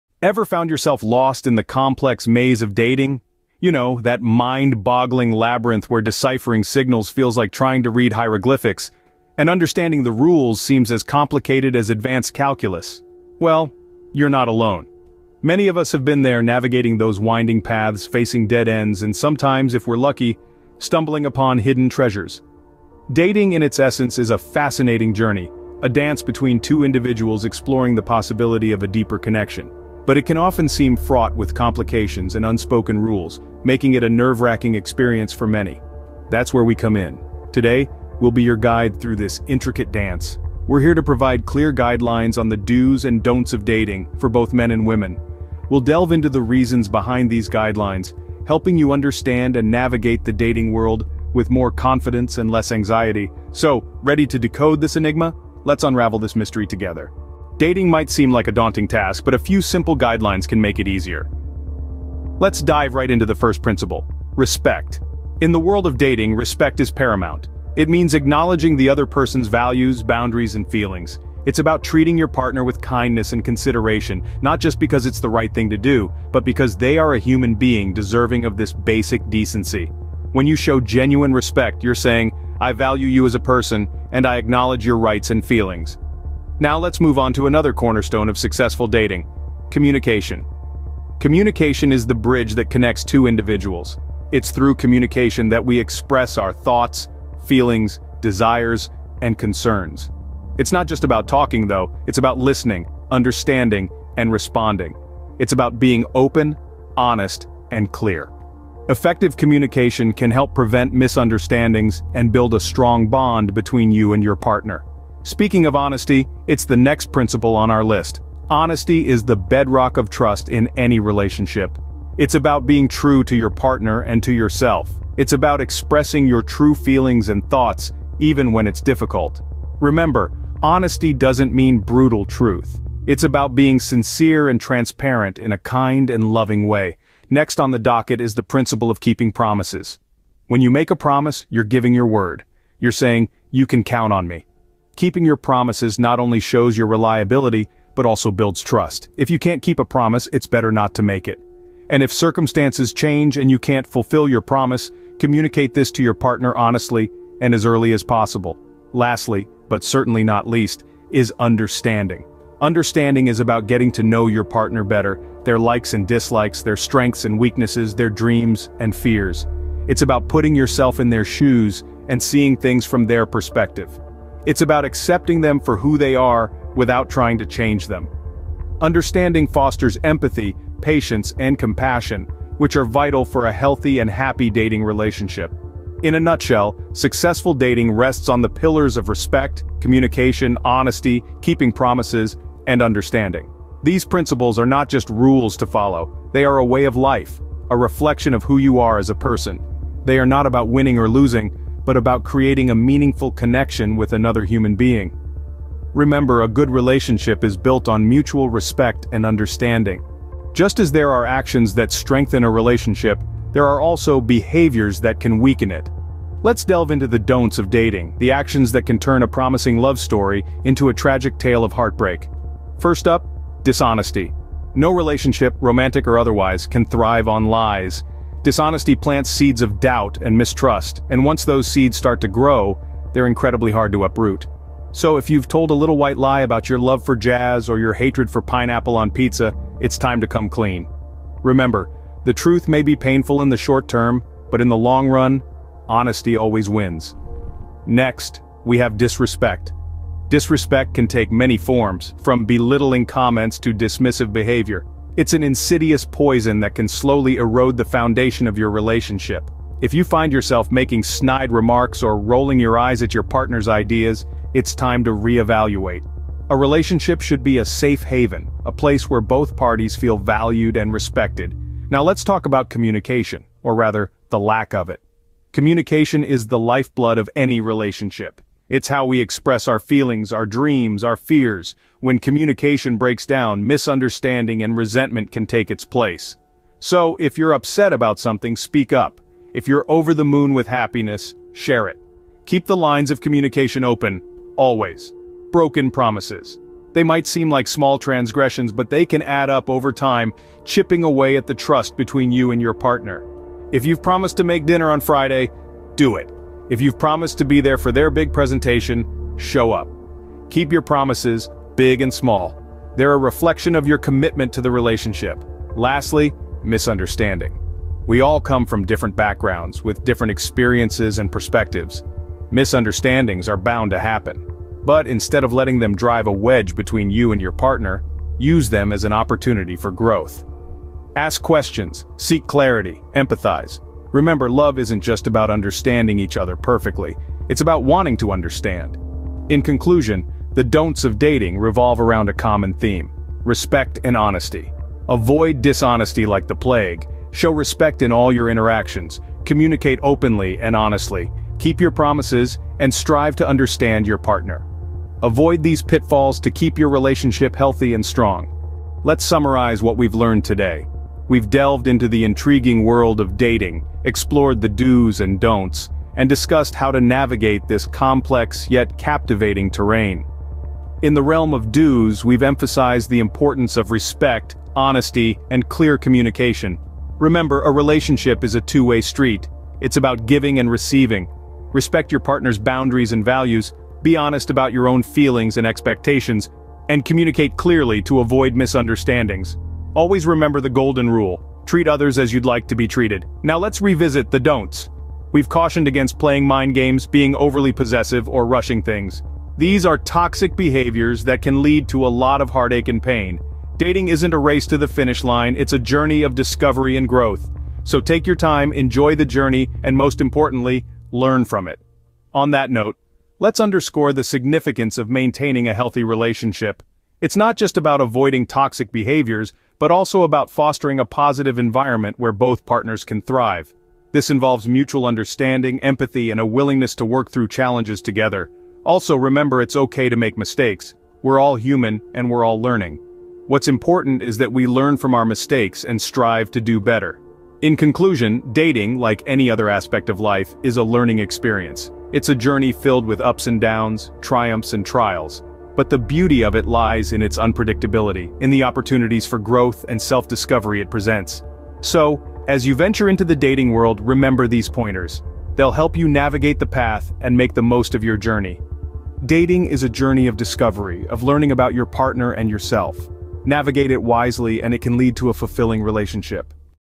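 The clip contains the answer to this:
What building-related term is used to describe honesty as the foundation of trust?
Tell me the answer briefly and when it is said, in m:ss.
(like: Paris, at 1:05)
bedrock, at 1:59.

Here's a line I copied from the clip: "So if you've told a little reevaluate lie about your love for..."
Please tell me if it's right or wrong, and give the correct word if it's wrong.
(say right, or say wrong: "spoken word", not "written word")
wrong: "white", not "reevaluate".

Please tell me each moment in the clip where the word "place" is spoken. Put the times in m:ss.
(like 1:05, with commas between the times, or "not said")
4:28, 4:45.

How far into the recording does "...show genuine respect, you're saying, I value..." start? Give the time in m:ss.
1:20.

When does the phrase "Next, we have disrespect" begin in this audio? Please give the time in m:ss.
4:07.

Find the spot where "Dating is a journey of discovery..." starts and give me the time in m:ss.
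7:39.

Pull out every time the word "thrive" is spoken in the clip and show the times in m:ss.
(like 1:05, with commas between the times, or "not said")
3:46, 7:03.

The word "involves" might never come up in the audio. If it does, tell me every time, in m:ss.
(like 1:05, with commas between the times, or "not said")
7:04.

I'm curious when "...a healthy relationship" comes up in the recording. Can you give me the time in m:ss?
6:55.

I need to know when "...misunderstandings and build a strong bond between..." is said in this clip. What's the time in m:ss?
1:50.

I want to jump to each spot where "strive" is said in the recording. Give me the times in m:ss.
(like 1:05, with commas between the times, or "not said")
5:52, 7:15.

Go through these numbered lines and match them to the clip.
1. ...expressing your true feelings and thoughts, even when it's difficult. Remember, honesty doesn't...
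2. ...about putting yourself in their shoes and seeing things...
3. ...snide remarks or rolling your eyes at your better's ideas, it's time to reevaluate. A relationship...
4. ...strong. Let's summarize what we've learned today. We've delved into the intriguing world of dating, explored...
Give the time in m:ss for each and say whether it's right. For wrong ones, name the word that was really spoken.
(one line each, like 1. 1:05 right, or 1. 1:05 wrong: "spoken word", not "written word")
1. 2:05 right
2. 2:50 right
3. 4:21 wrong: "partner", not "better"
4. 5:58 right.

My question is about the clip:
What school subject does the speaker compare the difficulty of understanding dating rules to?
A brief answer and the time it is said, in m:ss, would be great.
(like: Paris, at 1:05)
advanced calculus, at 0:11.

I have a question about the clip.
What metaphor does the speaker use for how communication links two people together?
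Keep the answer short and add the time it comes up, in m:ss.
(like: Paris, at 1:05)
the bridge, at 1:32.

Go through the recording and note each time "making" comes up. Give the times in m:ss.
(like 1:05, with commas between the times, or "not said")
0:33, 4:20.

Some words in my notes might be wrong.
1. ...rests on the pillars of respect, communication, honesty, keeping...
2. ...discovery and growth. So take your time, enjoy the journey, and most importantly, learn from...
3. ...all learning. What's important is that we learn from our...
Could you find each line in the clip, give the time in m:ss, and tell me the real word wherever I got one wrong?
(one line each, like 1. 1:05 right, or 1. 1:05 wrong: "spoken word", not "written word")
1. 3:07 right
2. 6:46 right
3. 7:12 right.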